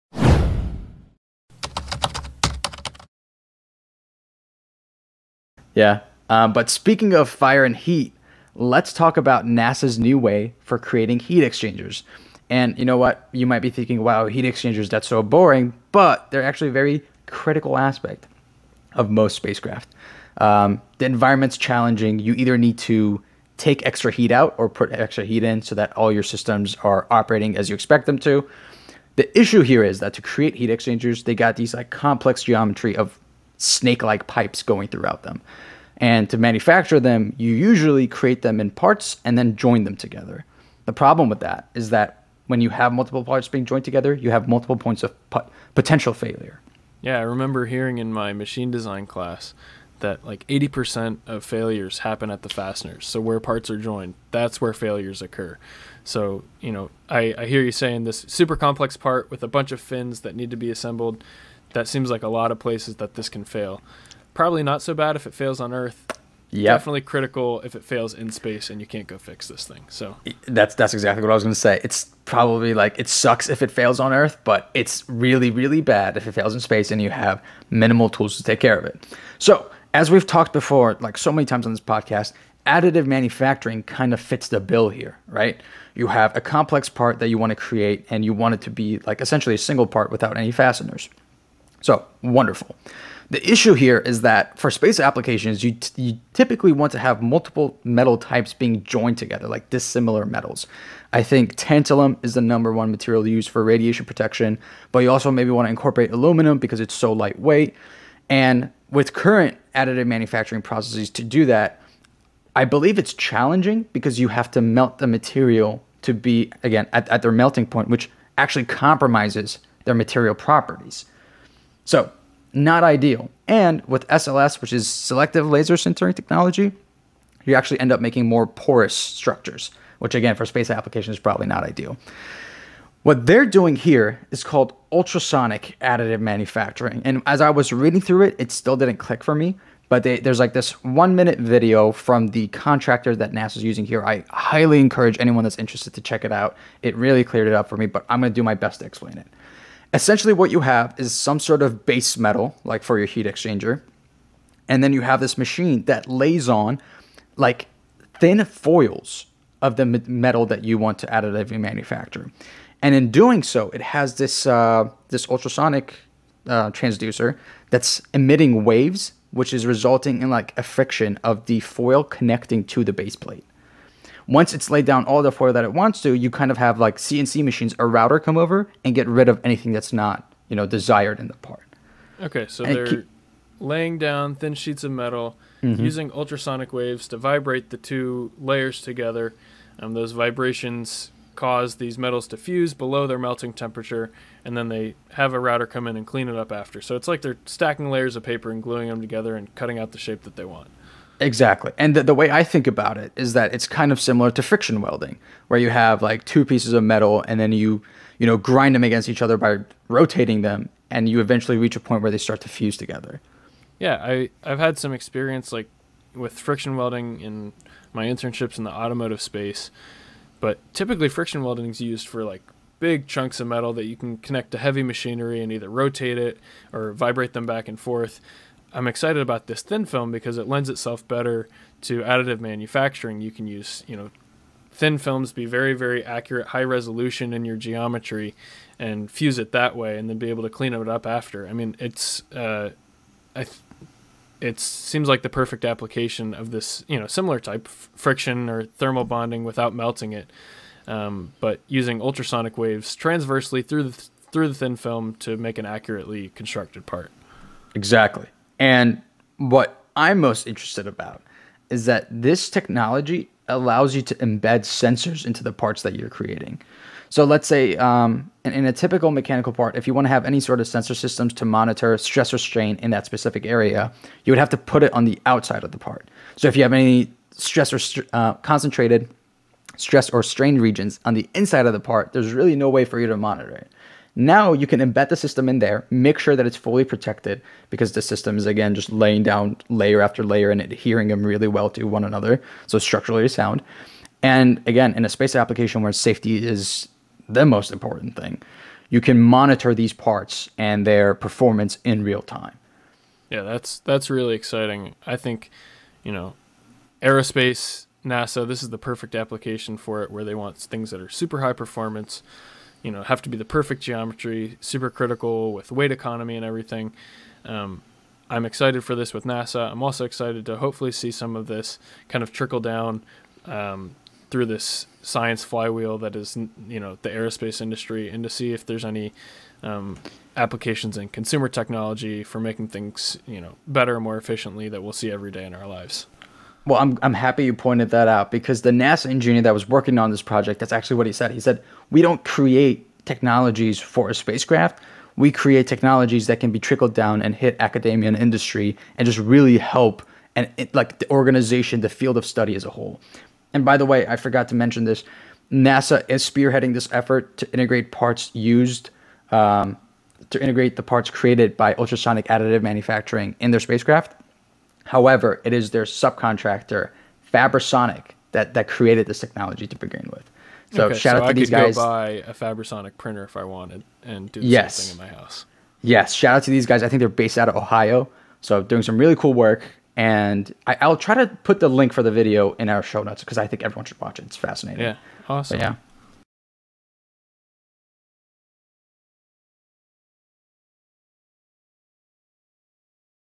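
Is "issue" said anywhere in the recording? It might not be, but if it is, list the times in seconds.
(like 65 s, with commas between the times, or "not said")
29 s, 93 s.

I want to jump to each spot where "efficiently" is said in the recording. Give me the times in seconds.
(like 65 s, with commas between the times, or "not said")
334 s.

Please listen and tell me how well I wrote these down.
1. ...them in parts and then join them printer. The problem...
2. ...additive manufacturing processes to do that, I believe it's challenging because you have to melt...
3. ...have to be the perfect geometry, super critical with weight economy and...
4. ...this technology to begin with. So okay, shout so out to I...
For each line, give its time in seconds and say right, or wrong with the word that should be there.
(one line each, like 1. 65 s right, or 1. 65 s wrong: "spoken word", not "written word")
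1. 38 s wrong: "together", not "printer"
2. 109 s right
3. 313 s right
4. 369 s right.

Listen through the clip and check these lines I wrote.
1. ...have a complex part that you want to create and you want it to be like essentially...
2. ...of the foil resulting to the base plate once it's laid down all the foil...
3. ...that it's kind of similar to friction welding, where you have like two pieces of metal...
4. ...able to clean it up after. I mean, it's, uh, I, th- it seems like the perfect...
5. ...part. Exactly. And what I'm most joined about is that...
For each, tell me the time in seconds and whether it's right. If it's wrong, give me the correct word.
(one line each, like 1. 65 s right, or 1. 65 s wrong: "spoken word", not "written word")
1. 86 s right
2. 171 s wrong: "connecting", not "resulting"
3. 203 s right
4. 240 s right
5. 256 s wrong: "interested", not "joined".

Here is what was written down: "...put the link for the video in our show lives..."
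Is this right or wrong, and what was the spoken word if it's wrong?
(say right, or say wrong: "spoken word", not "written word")
wrong: "notes", not "lives".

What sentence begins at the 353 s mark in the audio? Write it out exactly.
And by the way, I forgot to mention this NASA is spearheading this effort to integrate parts used.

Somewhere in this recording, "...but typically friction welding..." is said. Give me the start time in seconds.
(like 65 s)
220 s.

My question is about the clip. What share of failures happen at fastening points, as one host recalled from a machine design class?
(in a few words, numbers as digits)
80%.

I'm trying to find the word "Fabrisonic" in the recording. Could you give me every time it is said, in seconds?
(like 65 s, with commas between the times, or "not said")
367 s, 372 s.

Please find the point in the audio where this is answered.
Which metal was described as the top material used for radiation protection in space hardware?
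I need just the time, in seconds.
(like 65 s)
101 s.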